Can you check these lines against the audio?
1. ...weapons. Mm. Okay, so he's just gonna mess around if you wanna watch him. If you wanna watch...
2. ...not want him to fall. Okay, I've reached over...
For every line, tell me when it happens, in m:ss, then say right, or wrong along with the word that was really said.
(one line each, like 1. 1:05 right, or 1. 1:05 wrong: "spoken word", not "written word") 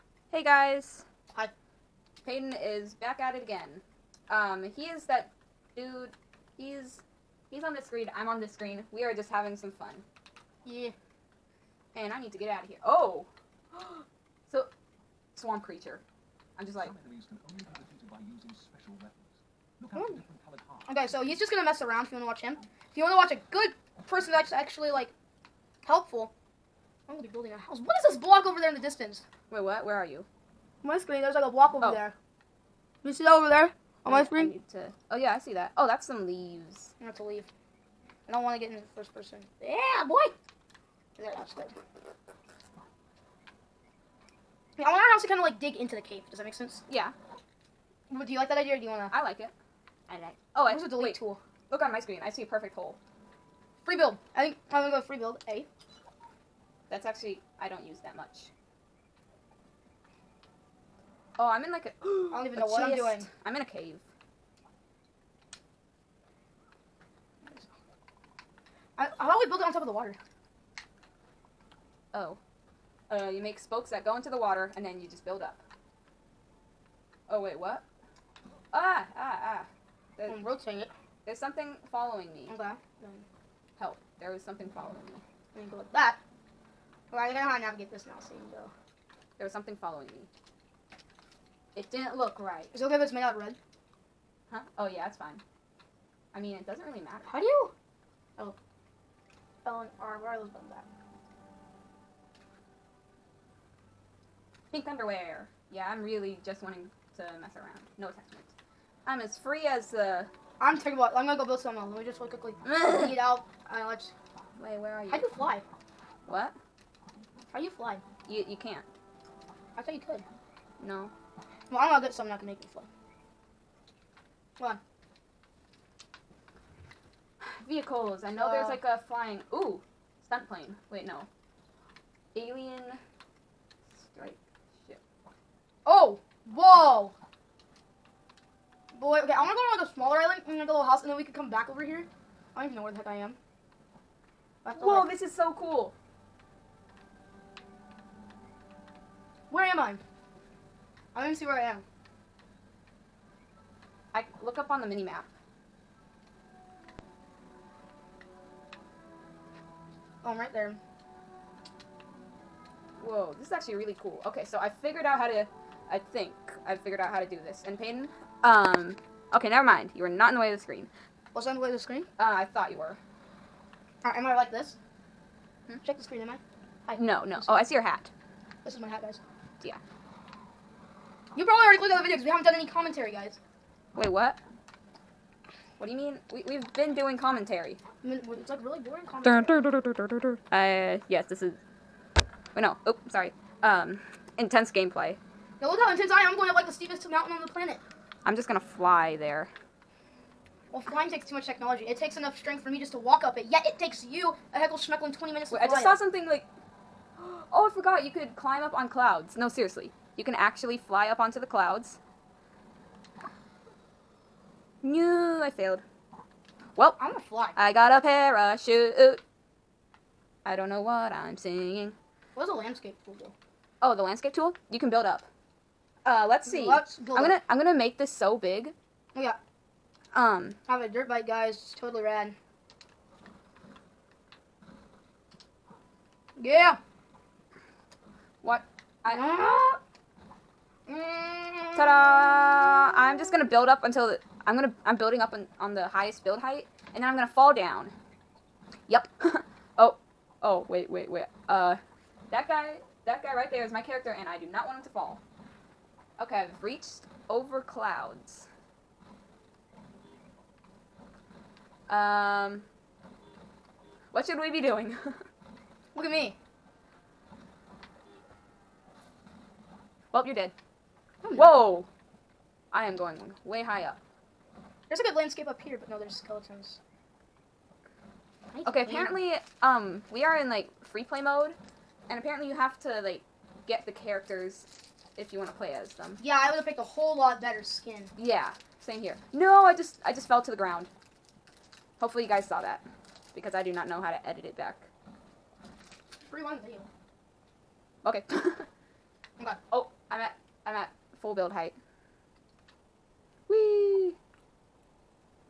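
1. 0:18 right
2. 4:14 right.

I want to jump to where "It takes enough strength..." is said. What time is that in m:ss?
3:21.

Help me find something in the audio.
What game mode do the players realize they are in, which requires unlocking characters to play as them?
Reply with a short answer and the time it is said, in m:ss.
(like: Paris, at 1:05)
Free play mode, at 4:40.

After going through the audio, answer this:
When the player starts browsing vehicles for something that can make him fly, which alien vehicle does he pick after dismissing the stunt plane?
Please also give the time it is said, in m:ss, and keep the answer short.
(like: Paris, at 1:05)
Alien strike ship, at 2:12.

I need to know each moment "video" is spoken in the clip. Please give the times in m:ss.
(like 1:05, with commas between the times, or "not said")
3:02, 4:56.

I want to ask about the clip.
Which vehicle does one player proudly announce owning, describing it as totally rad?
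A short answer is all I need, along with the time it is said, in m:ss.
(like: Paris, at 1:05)
Dirt bike, at 3:50.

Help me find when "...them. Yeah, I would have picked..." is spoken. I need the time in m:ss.
4:45.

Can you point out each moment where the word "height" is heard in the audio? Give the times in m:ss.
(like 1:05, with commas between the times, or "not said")
4:06, 5:01.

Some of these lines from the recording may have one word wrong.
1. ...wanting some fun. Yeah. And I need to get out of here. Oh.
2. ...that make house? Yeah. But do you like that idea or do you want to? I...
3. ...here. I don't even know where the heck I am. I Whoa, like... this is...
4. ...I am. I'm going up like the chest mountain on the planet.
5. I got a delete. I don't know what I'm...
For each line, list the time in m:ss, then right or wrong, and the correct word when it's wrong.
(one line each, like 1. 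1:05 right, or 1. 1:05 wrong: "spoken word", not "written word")
1. 0:09 wrong: "having", not "wanting"
2. 0:46 wrong: "sense", not "house"
3. 2:21 right
4. 3:16 wrong: "steepest", not "chest"
5. 3:37 wrong: "parachute", not "delete".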